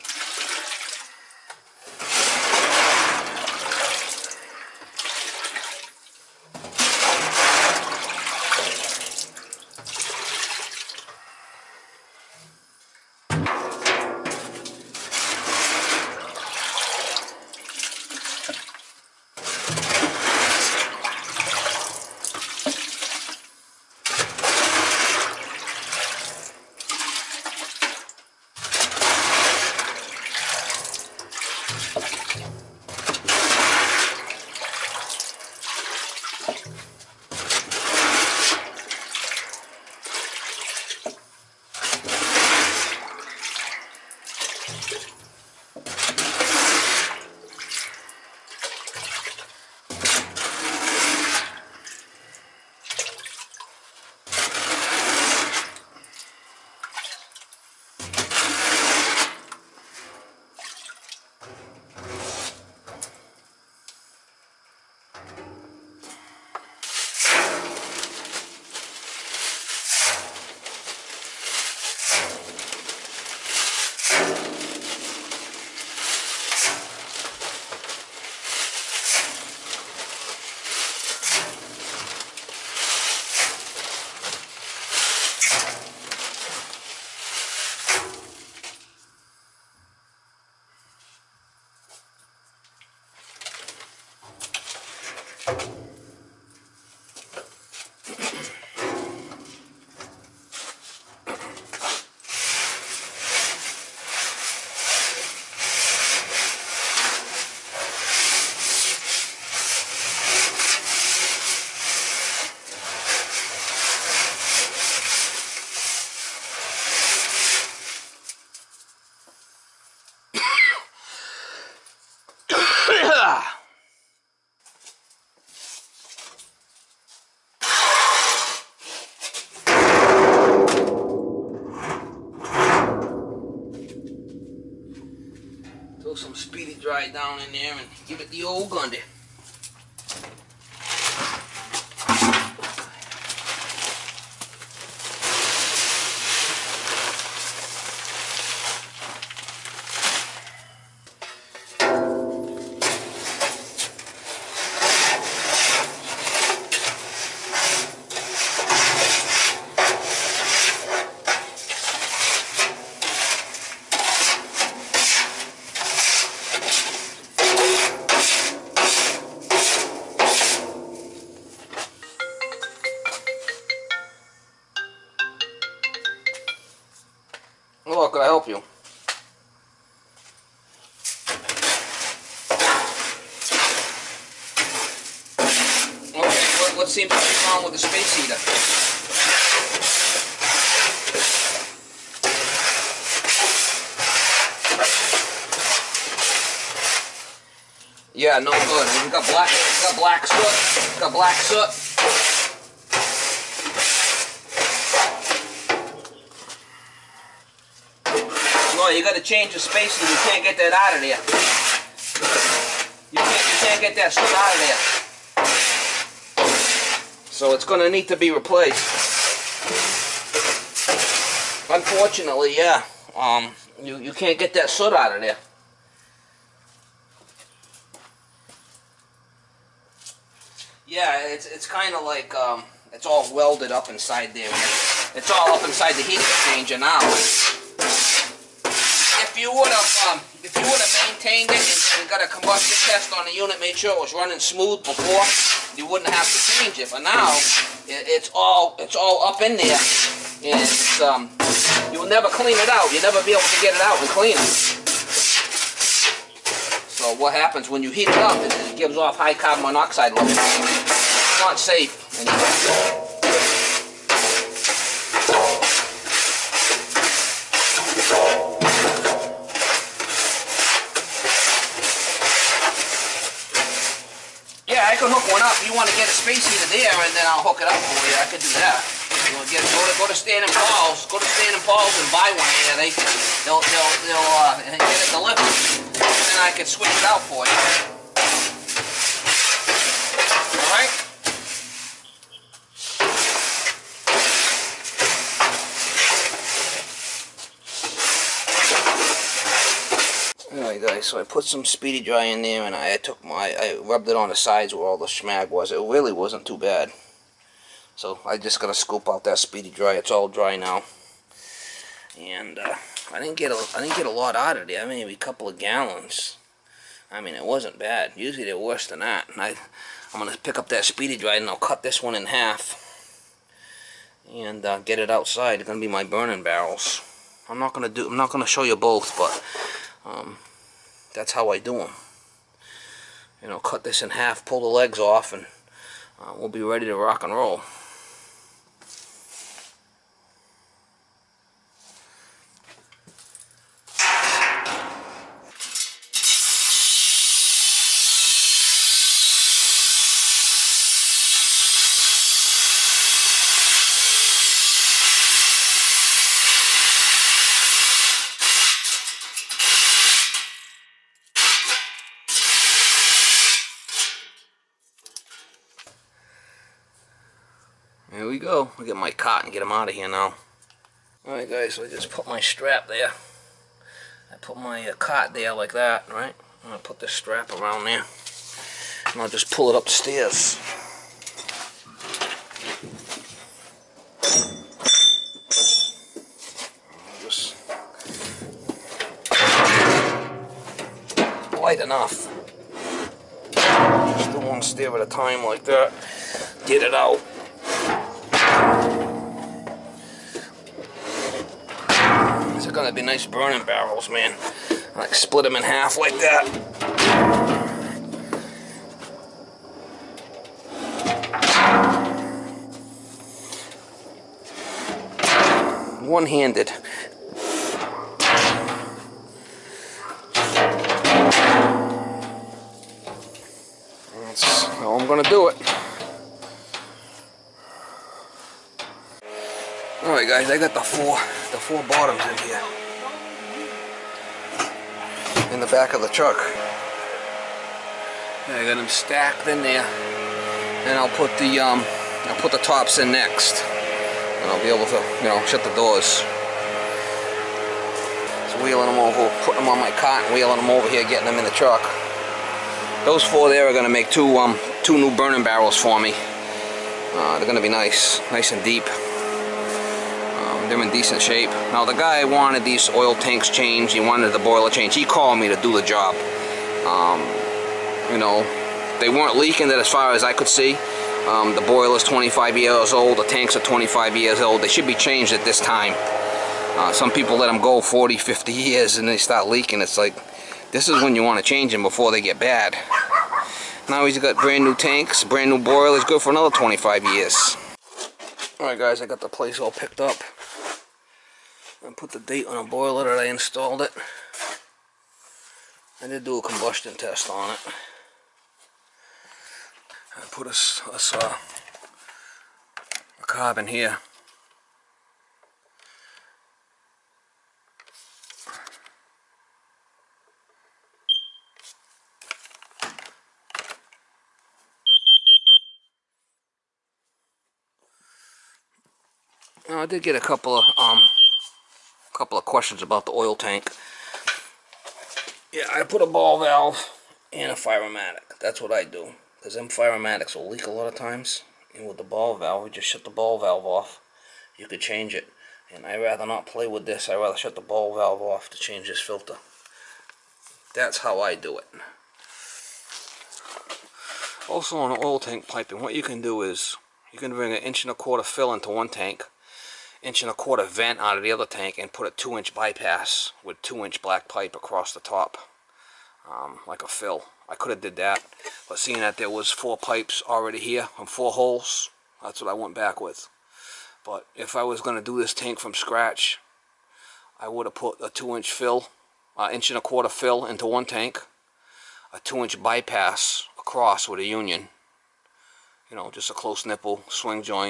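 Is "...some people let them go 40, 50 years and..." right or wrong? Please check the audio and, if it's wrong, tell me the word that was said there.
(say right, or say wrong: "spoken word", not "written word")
right.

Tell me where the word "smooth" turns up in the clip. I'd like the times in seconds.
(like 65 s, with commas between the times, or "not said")
244 s.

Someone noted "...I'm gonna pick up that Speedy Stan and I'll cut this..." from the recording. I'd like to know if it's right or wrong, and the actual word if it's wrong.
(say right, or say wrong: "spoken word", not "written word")
wrong: "Dry", not "Stan".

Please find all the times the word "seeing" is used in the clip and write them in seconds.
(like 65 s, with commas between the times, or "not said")
558 s.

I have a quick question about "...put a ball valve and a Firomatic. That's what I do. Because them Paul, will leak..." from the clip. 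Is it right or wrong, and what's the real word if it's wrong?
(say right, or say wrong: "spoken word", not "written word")
wrong: "Firomatics", not "Paul".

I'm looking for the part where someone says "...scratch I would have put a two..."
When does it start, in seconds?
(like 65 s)
565 s.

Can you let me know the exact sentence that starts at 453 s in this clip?
Those four there are gonna make two um two new burning barrels for me.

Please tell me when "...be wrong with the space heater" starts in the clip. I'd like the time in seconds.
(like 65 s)
187 s.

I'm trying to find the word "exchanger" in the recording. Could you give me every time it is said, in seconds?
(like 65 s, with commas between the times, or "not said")
236 s.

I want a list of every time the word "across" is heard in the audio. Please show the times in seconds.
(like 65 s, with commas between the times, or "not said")
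554 s, 573 s.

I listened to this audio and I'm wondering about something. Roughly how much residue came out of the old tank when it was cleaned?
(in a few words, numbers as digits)
A couple of gallons.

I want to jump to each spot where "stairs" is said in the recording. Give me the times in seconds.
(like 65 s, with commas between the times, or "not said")
379 s, 394 s.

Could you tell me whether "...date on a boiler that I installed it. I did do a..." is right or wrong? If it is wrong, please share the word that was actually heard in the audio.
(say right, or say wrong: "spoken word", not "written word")
right.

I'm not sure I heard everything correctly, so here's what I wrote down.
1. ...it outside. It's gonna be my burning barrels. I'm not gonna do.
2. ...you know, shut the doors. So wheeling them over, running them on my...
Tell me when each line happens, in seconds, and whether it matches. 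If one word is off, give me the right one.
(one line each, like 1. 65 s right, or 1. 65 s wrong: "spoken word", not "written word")
1. 324 s right
2. 445 s wrong: "putting", not "running".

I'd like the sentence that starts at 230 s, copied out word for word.
Yeah, it's, it's kind of like, um, it's all welded up inside there.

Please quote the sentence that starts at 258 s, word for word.
It, it gives off high carbon monoxide levels.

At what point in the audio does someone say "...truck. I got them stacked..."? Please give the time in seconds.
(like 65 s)
436 s.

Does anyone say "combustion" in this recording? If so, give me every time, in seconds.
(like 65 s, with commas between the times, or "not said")
242 s, 496 s.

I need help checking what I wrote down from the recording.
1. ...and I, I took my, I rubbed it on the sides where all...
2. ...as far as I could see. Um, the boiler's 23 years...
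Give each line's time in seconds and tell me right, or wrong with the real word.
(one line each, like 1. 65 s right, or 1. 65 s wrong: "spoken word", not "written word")
1. 302 s right
2. 469 s wrong: "25", not "23".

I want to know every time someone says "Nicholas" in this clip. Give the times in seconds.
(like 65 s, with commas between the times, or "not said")
not said.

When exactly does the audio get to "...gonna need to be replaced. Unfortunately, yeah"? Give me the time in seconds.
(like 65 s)
217 s.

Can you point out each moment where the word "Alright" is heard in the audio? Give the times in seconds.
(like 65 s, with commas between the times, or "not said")
371 s, 430 s, 488 s.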